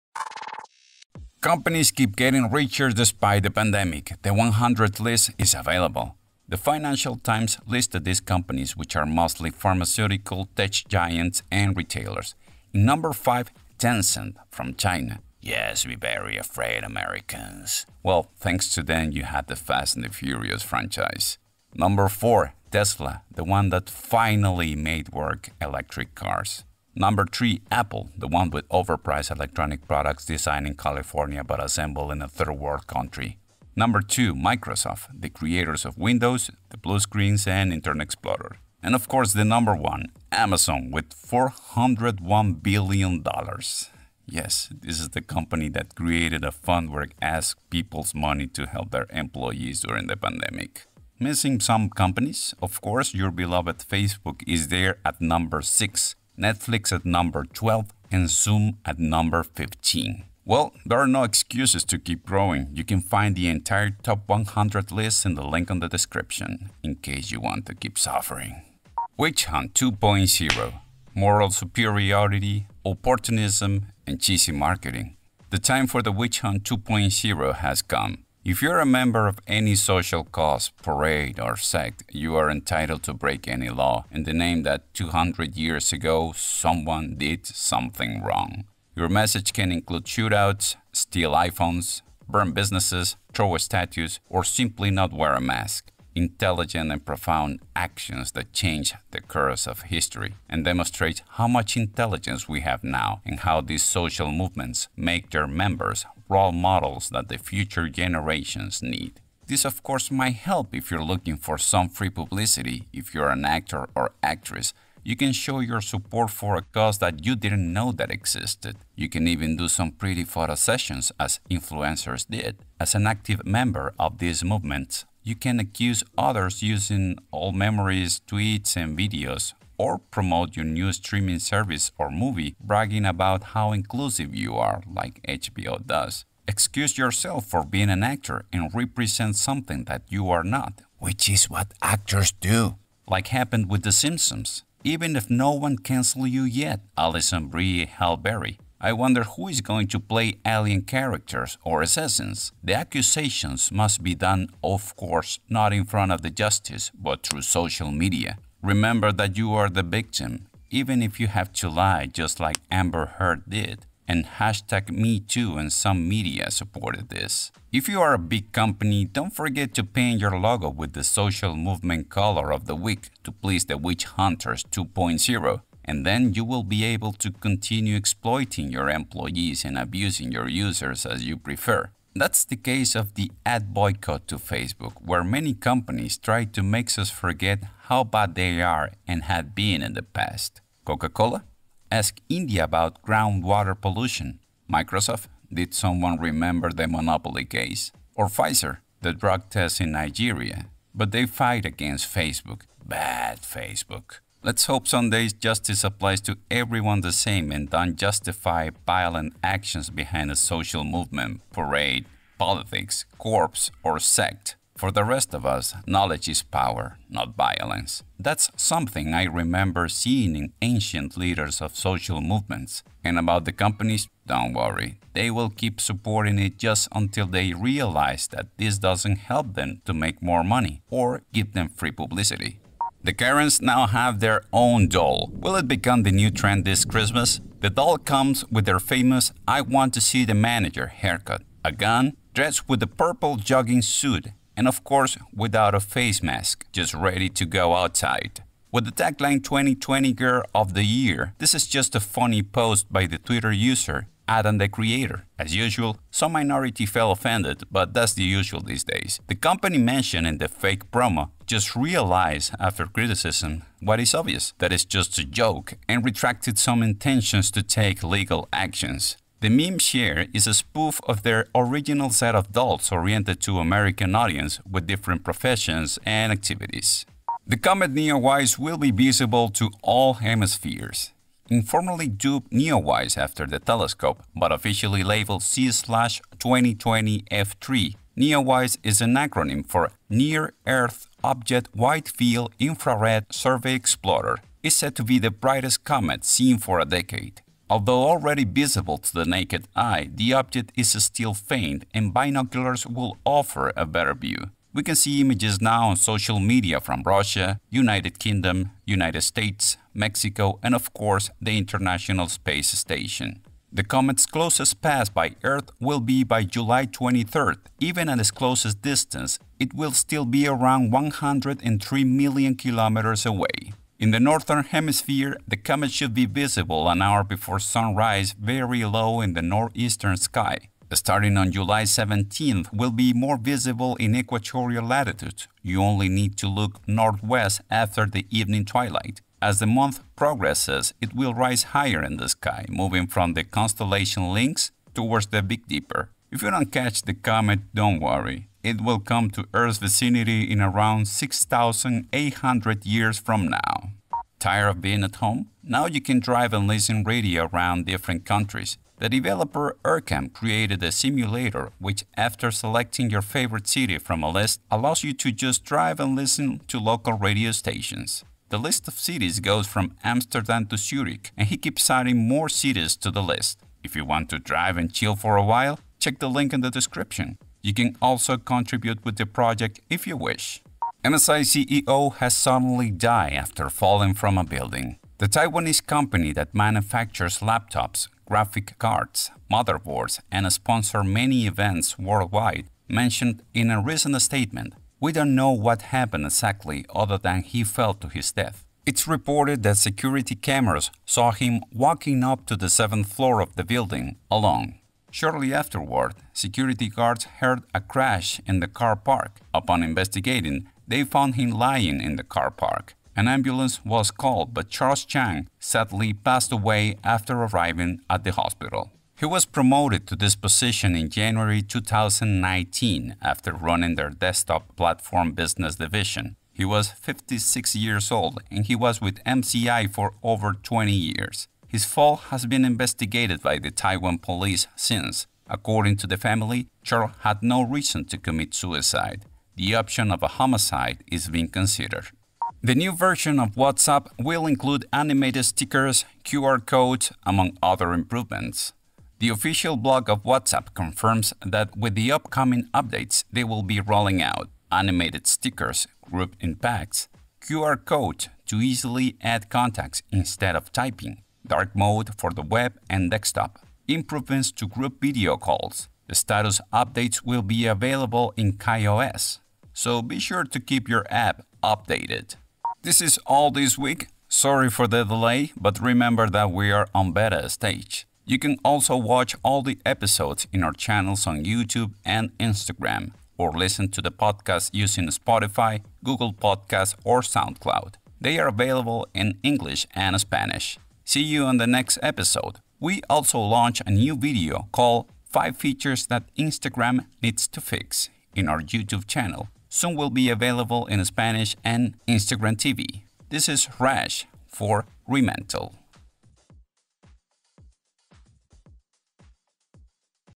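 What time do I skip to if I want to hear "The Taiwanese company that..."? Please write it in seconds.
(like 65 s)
385 s.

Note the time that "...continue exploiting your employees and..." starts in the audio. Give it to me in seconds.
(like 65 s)
177 s.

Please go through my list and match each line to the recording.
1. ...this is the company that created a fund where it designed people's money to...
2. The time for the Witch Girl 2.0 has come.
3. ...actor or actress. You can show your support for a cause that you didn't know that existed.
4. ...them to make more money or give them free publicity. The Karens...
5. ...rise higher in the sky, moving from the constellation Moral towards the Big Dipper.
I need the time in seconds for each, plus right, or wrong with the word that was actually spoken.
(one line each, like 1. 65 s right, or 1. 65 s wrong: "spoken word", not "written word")
1. 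44 s wrong: "asked", not "designed"
2. 75 s wrong: "Hunt", not "Girl"
3. 113 s right
4. 229 s right
5. 341 s wrong: "Lynx", not "Moral".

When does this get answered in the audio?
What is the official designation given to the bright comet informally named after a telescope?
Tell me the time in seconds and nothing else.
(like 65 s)
285 s.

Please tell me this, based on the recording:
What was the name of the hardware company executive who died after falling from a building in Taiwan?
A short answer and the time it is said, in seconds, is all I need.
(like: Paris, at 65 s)
Charles Chang, at 414 s.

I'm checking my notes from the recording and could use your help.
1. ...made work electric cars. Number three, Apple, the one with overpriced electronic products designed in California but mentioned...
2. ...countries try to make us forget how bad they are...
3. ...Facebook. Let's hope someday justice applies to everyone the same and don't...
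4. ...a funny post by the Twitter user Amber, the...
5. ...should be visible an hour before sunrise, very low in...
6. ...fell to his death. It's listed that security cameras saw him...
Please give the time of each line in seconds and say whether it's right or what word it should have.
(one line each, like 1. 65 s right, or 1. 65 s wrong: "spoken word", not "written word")
1. 24 s wrong: "assembled", not "mentioned"
2. 185 s wrong: "companies", not "countries"
3. 203 s right
4. 251 s wrong: "Adam", not "Amber"
5. 325 s right
6. 397 s wrong: "reported", not "listed".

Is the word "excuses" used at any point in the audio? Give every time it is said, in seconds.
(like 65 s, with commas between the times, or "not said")
61 s, 136 s.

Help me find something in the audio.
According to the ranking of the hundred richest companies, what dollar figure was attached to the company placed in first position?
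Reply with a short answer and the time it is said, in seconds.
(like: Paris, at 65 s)
$401 billion, at 41 s.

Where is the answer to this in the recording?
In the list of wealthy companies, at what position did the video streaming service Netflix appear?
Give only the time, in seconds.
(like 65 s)
57 s.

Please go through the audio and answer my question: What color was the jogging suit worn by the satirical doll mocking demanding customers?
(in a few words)
Purple.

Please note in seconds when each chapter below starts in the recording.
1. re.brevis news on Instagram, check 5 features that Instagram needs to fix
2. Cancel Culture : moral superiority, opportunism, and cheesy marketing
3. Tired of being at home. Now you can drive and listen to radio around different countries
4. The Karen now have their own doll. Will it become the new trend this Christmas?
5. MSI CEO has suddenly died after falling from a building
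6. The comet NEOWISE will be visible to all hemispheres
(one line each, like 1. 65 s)
1. 472 s
2. 68 s
3. 354 s
4. 232 s
5. 380 s
6. 277 s.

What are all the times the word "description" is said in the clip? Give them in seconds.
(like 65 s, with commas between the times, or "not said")
65 s, 376 s.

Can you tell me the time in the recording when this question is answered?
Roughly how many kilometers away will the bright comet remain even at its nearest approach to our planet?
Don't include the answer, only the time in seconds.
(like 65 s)
320 s.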